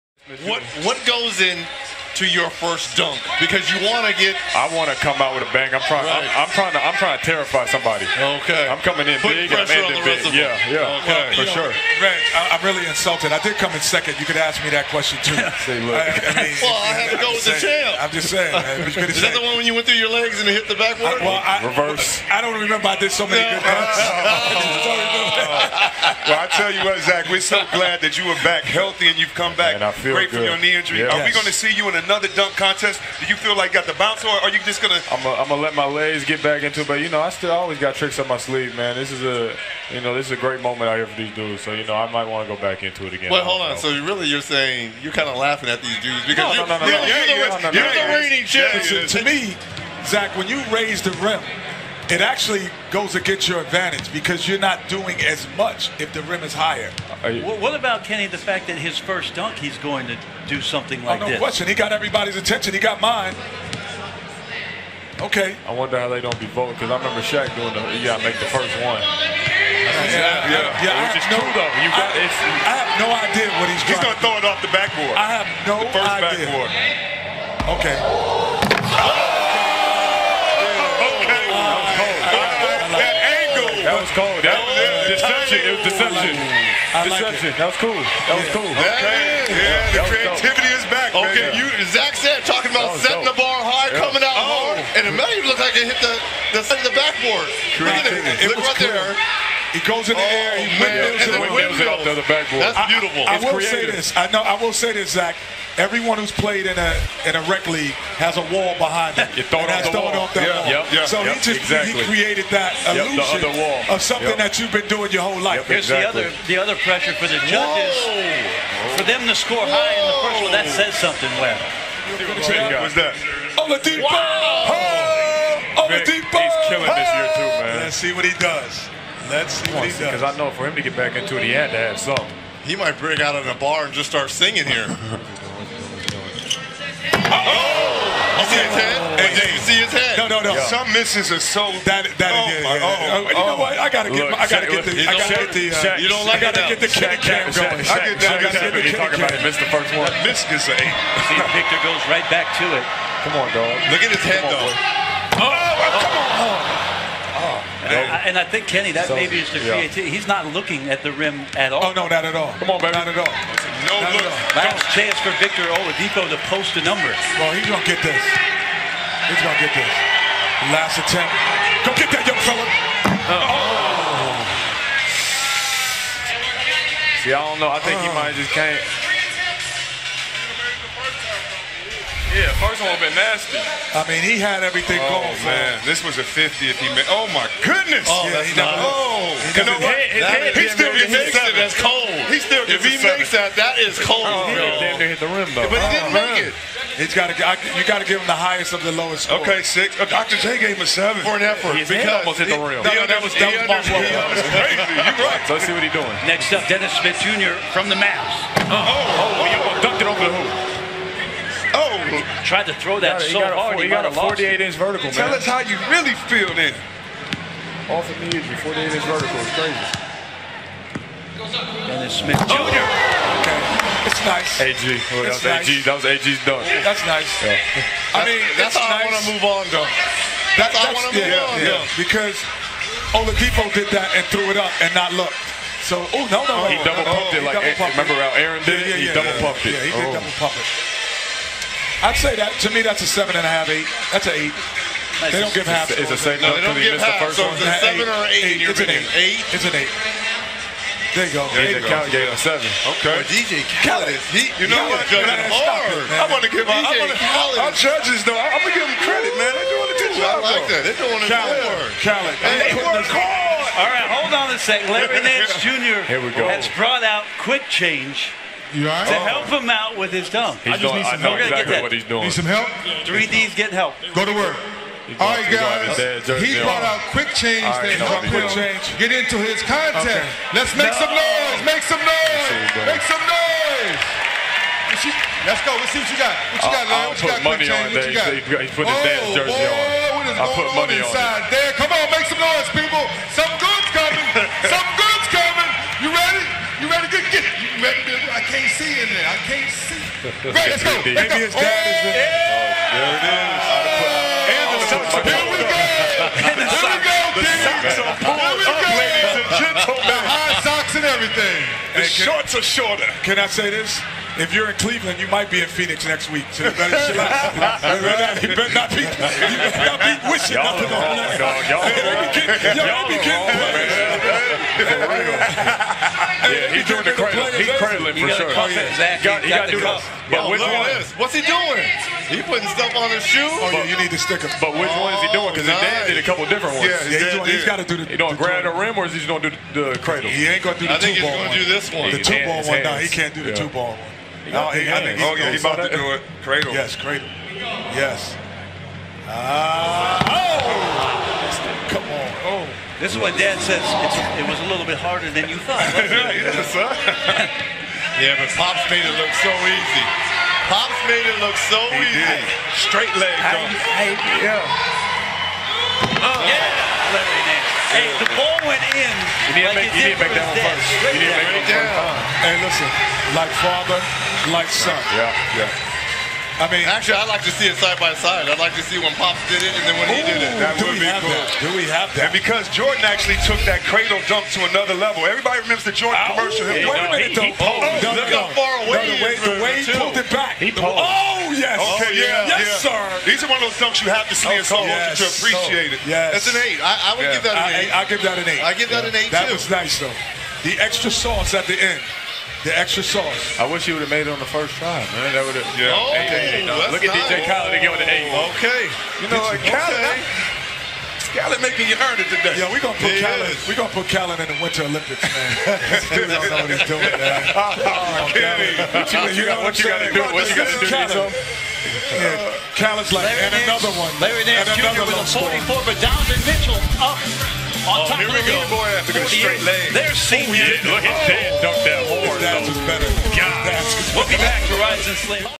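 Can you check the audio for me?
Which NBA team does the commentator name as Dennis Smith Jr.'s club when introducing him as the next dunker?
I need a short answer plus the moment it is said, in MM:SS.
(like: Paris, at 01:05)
Mavs, at 03:27.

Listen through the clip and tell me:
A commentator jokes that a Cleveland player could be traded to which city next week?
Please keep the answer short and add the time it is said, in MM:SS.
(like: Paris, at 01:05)
Phoenix, at 05:15.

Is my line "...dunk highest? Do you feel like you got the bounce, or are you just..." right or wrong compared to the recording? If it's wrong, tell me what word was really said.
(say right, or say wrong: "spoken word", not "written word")
wrong: "contest", not "highest".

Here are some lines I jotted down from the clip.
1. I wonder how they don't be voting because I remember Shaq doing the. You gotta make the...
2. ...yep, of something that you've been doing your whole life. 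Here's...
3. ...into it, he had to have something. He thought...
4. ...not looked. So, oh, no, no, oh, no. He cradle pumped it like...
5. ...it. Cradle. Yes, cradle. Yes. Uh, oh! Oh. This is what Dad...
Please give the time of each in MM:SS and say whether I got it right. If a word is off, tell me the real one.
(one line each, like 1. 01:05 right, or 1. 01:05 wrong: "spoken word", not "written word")
1. 01:05 right
2. 01:53 right
3. 02:11 wrong: "might", not "thought"
4. 03:54 wrong: "double", not "cradle"
5. 05:46 right.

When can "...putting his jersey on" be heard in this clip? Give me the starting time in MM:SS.
04:48.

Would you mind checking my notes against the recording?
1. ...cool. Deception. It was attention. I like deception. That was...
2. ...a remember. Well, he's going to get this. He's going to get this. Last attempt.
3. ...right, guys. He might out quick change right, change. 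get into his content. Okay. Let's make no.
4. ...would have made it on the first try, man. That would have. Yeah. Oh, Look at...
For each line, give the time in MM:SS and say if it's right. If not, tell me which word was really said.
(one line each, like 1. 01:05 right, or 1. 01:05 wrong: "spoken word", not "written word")
1. 01:24 wrong: "deception", not "attention"
2. 02:46 wrong: "number", not "remember"
3. 04:35 wrong: "brought", not "might"
4. 06:43 right.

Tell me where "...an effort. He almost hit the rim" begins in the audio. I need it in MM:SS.
03:21.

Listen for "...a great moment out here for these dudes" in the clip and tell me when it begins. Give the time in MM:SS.
00:40.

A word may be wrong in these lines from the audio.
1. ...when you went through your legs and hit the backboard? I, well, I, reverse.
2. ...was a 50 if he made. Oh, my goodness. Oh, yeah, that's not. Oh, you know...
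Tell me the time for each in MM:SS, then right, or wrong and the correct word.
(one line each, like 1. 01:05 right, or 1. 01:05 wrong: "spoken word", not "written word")
1. 00:19 right
2. 03:05 right.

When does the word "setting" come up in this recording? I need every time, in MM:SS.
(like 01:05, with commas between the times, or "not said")
01:32.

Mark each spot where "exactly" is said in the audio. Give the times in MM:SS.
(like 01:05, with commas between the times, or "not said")
01:51, 01:55, 04:31, 05:28.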